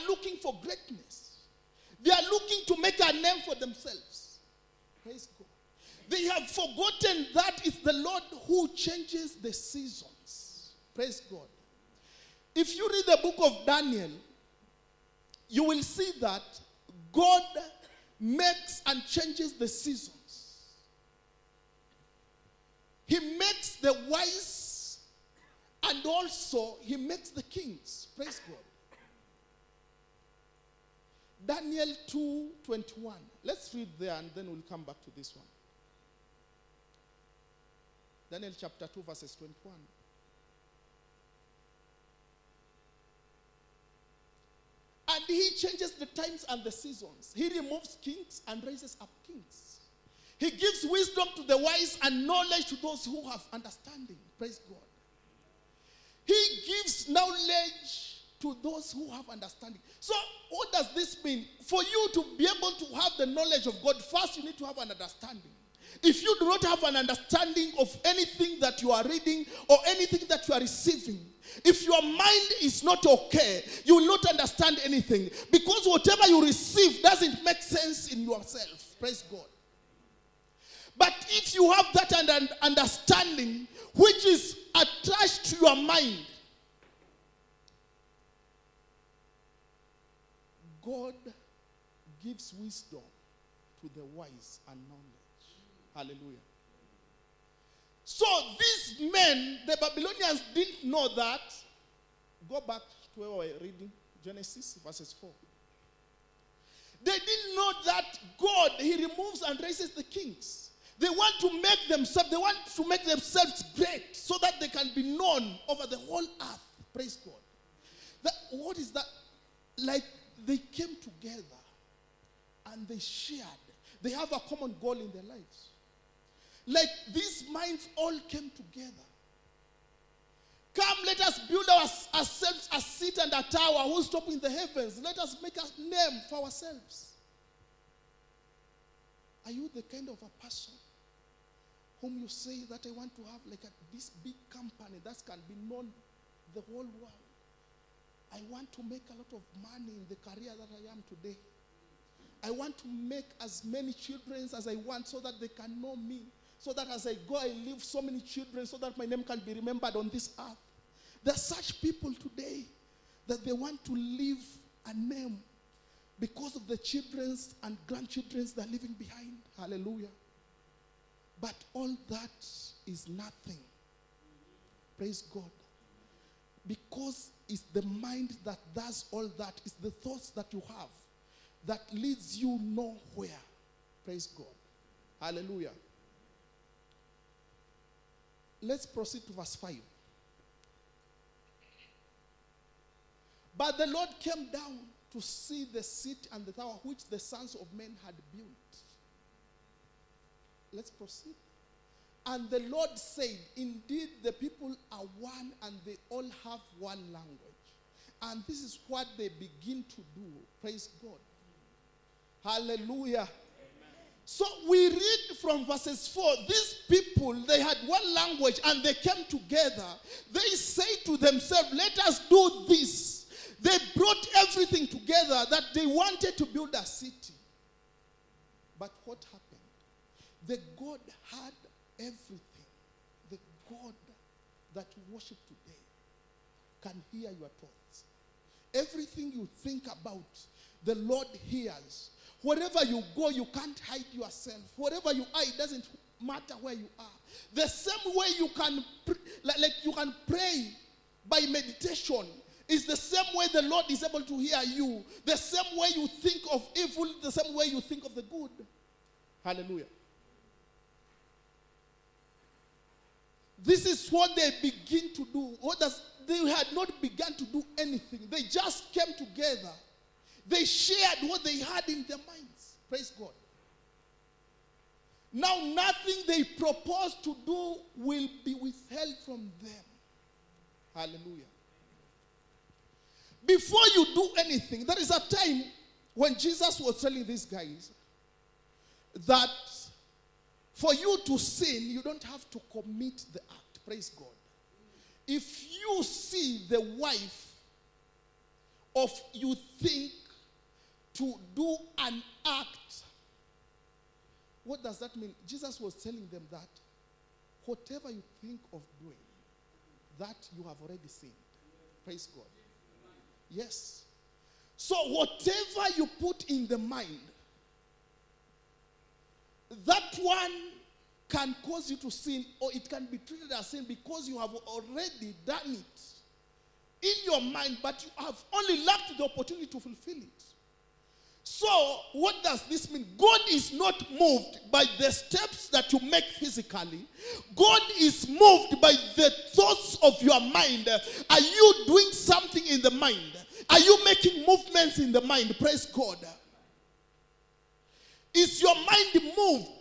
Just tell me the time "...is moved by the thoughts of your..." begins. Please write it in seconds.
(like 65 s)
337 s.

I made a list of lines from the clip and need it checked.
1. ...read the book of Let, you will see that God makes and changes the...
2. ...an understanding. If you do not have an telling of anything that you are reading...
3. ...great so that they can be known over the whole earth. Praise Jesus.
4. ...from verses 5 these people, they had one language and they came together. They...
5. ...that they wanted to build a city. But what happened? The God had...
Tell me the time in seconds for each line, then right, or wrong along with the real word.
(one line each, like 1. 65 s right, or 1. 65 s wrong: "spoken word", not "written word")
1. 12 s wrong: "Daniel", not "Let"
2. 64 s wrong: "understanding", not "telling"
3. 113 s wrong: "God", not "Jesus"
4. 215 s wrong: "4", not "5"
5. 225 s right.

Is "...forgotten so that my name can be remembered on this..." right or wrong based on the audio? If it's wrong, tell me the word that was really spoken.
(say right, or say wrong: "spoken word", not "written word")
wrong: "children", not "forgotten".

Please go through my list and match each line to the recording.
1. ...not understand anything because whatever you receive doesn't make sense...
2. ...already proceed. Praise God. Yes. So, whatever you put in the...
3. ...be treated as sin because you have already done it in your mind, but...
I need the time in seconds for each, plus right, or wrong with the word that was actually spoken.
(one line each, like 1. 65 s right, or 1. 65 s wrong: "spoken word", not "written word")
1. 74 s right
2. 310 s wrong: "sinned", not "proceed"
3. 323 s right.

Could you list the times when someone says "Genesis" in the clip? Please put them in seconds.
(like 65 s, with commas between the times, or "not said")
104 s.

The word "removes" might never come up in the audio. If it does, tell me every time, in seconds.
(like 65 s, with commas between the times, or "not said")
47 s, 108 s.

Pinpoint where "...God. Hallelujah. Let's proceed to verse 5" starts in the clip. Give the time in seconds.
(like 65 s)
184 s.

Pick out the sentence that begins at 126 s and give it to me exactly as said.
Like these minds all came together.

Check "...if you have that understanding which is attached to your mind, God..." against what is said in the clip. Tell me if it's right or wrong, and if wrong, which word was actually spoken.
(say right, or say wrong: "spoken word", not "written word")
right.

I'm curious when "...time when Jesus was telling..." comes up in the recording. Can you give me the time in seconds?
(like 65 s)
285 s.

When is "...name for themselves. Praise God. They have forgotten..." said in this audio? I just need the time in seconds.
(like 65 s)
3 s.